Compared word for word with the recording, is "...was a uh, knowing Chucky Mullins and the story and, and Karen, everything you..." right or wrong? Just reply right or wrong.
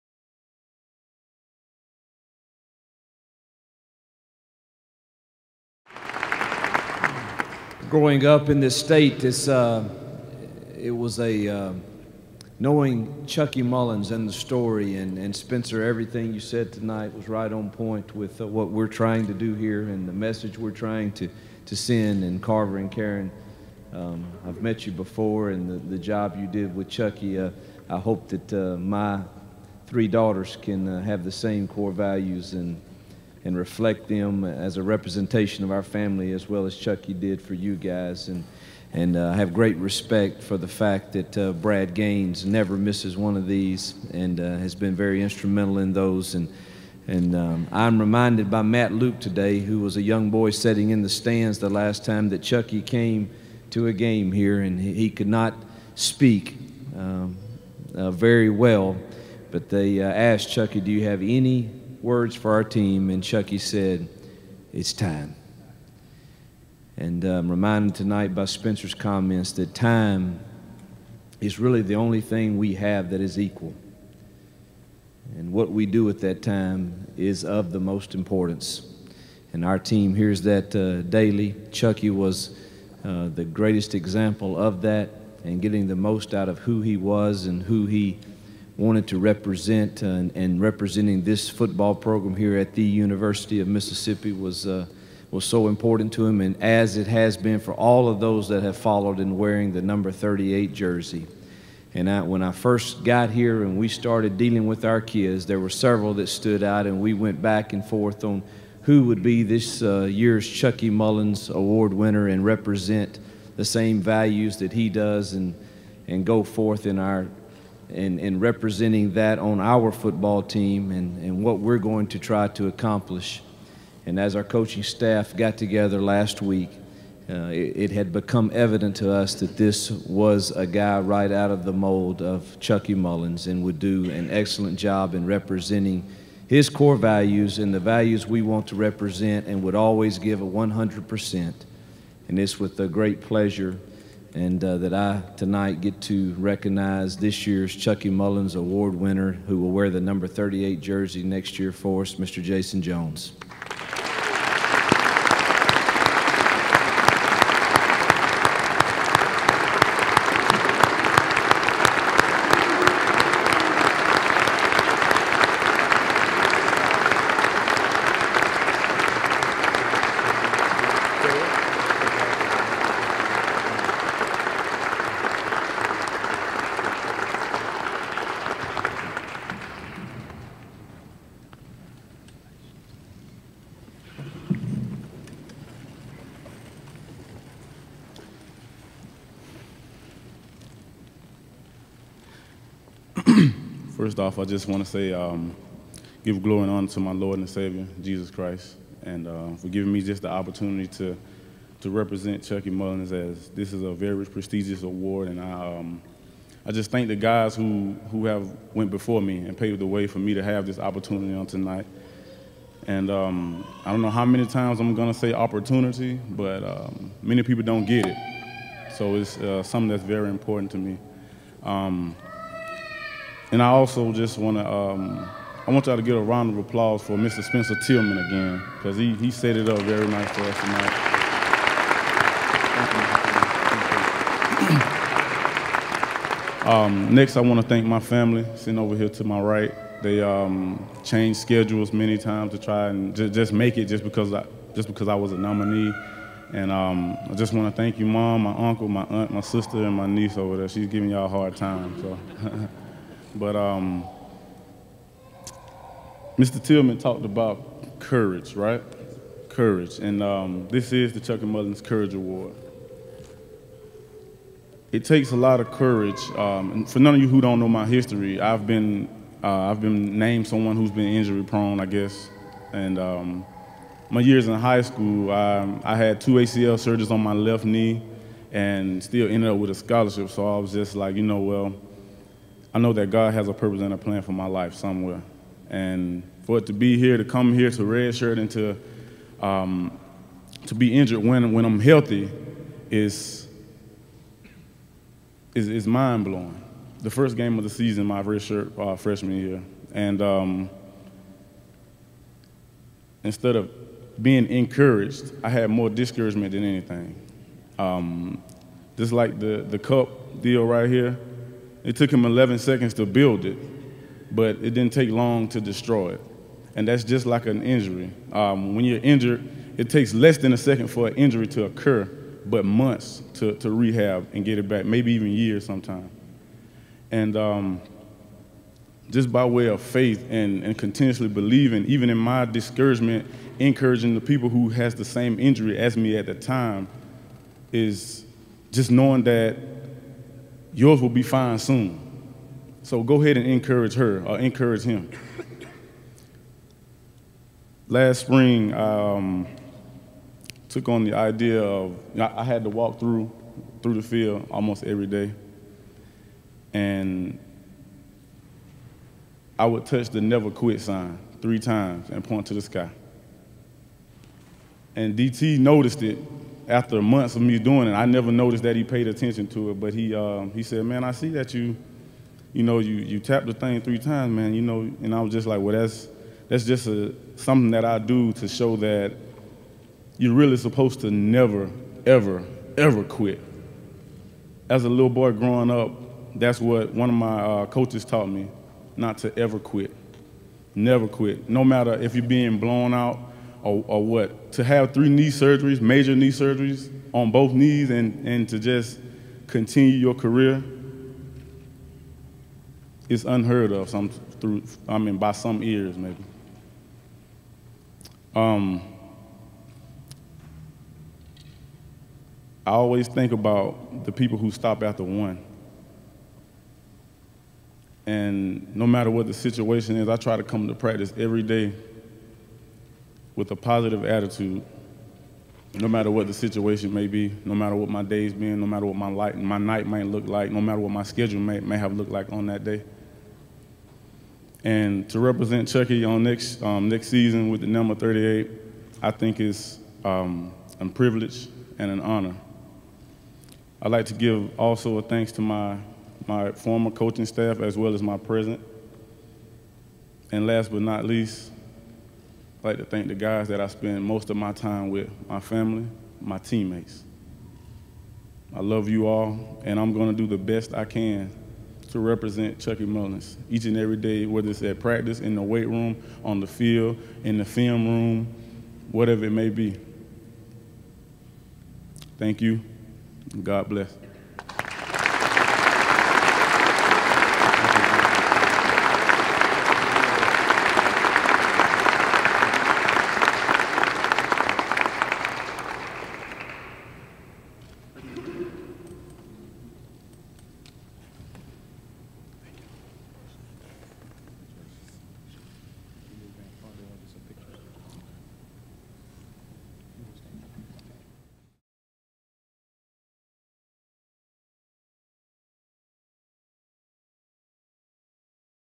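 wrong.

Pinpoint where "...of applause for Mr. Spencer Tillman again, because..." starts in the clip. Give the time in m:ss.
3:46.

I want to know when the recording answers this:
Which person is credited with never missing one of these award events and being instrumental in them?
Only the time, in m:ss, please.
0:41.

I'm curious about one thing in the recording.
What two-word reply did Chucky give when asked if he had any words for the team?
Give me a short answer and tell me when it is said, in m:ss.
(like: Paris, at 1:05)
It's time, at 1:04.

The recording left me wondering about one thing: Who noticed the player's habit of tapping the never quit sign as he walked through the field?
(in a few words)
DT.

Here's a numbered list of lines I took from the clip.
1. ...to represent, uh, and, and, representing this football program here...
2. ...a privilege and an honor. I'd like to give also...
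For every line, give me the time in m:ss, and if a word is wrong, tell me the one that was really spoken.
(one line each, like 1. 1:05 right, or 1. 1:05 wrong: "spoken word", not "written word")
1. 1:29 right
2. 7:20 right.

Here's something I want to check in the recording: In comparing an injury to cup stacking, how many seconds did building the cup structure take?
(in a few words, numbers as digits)
11.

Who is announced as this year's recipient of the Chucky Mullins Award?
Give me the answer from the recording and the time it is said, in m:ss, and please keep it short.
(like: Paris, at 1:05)
Jason Jones, at 2:32.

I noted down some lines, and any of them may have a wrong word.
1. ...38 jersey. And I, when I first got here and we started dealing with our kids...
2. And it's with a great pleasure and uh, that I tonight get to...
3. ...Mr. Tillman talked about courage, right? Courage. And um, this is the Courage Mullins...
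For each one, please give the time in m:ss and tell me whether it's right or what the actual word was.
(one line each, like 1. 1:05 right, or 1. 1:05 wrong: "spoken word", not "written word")
1. 1:40 right
2. 2:22 right
3. 4:16 wrong: "Chucky", not "Courage".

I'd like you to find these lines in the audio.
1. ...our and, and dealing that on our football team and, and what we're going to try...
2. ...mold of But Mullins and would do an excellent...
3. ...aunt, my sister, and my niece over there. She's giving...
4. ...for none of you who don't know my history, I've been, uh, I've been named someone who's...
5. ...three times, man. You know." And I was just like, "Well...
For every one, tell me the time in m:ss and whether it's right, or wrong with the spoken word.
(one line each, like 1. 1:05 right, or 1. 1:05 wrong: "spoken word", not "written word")
1. 1:56 wrong: "representing", not "dealing"
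2. 2:11 wrong: "Chucky", not "But"
3. 4:09 right
4. 4:26 right
5. 6:13 right.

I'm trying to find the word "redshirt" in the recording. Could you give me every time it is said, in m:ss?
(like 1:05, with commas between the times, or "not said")
4:47, 4:58.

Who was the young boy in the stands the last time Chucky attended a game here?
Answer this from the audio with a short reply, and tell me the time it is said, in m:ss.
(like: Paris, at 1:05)
Matt Luke, at 0:48.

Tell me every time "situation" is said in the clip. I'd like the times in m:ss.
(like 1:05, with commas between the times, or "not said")
6:59, 7:06.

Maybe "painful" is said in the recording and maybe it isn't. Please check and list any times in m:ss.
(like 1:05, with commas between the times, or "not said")
not said.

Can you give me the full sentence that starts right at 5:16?
And that's just like an injury.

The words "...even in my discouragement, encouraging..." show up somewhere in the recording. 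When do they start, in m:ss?
5:31.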